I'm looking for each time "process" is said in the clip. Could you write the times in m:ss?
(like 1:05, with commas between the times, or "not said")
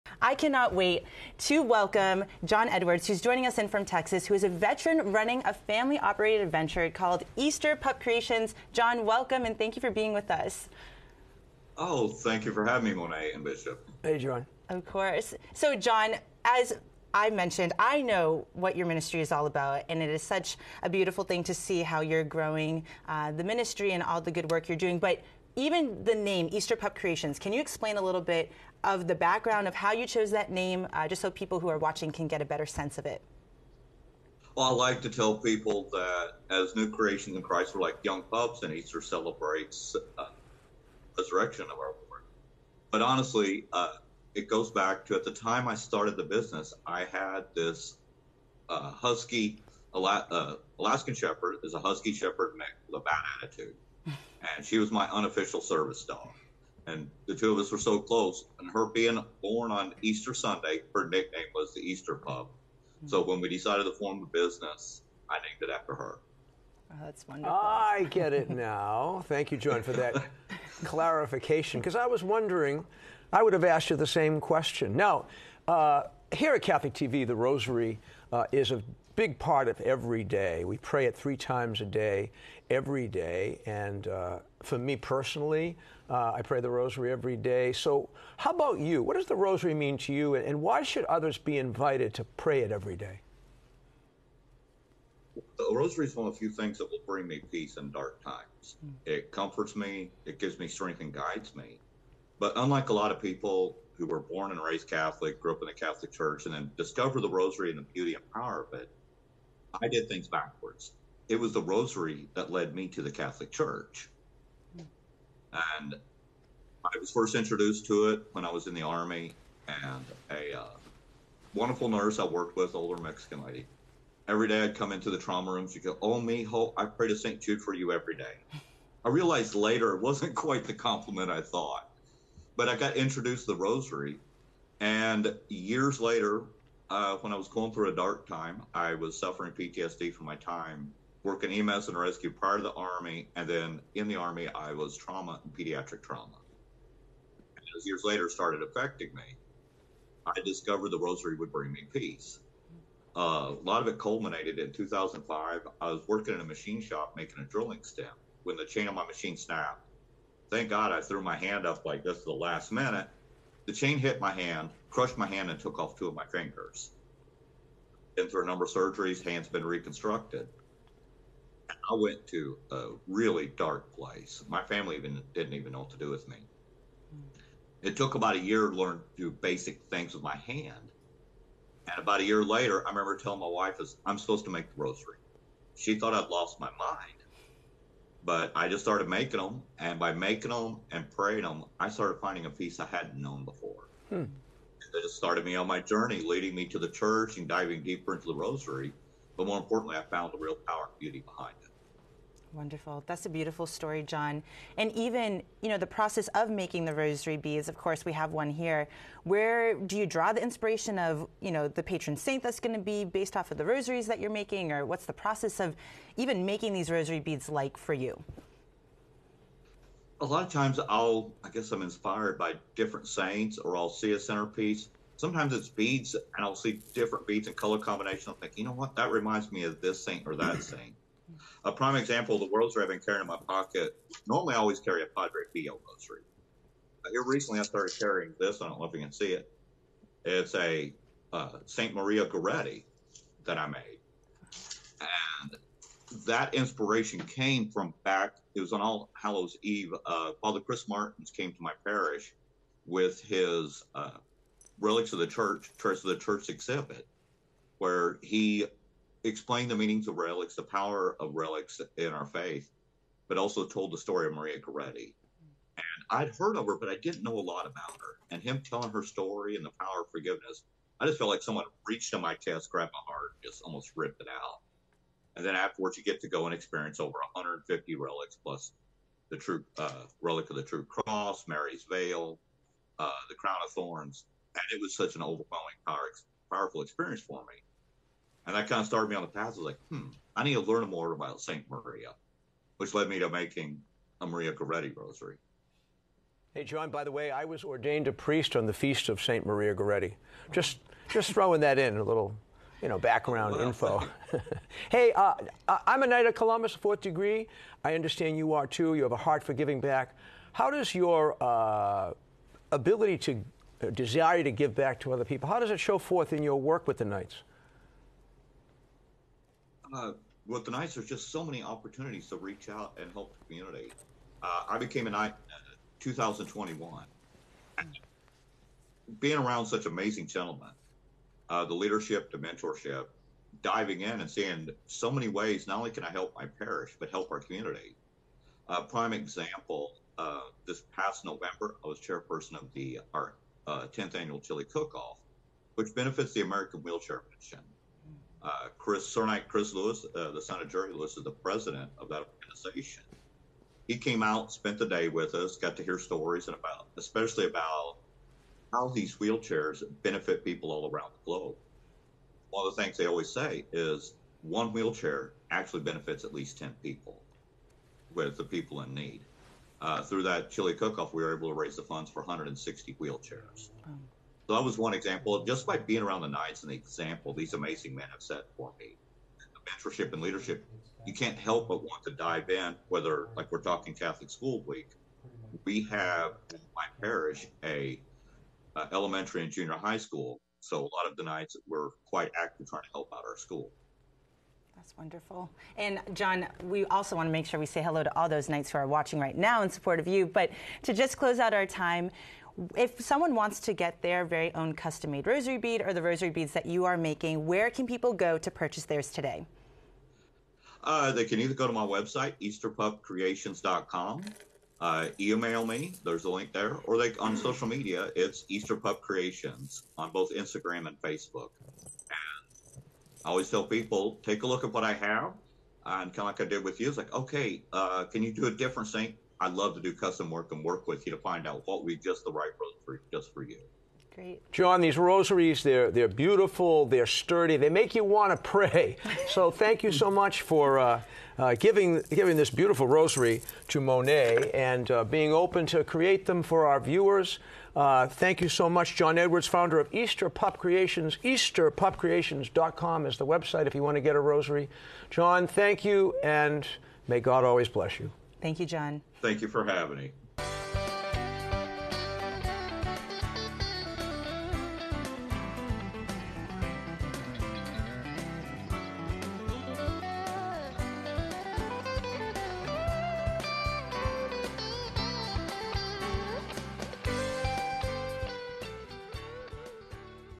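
3:25, 3:35.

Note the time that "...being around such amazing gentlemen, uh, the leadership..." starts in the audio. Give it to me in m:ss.
5:29.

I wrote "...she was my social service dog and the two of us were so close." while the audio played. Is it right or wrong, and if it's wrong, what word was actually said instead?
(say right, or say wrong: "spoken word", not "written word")
wrong: "unofficial", not "social".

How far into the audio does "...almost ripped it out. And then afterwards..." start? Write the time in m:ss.
4:33.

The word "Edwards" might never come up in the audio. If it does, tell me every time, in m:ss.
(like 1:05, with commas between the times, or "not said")
0:02, 7:29.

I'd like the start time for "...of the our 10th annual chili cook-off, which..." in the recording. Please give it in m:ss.
5:42.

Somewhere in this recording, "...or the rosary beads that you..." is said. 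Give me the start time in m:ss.
6:45.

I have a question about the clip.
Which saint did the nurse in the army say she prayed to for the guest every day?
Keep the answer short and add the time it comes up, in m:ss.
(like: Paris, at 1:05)
Saint Jude, at 2:07.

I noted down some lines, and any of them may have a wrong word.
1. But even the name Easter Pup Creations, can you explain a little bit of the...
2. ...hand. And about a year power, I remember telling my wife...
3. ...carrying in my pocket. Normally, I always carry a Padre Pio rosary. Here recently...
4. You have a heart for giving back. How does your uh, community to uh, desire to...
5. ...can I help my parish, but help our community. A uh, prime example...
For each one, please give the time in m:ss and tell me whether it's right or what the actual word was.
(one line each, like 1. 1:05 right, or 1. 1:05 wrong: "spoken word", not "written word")
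1. 0:24 right
2. 3:00 wrong: "later", not "power"
3. 3:52 right
4. 5:08 wrong: "ability", not "community"
5. 5:35 right.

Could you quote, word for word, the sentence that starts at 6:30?
So a lot of the Knights we're quite active trying to help out our school.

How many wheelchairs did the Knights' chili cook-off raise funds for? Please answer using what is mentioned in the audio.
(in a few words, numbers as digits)
160.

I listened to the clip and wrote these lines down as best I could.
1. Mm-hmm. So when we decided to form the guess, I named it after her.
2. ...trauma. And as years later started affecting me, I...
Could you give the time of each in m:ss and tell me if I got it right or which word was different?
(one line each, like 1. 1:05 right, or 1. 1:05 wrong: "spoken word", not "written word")
1. 1:02 wrong: "business", not "guess"
2. 2:26 right.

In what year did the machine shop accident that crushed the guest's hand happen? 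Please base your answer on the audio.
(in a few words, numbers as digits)
2005.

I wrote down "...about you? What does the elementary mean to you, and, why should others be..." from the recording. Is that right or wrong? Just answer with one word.
wrong.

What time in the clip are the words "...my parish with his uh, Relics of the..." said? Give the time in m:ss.
4:11.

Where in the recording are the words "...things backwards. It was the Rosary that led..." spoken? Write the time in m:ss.
1:50.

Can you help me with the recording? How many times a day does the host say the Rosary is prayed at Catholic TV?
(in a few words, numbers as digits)
3.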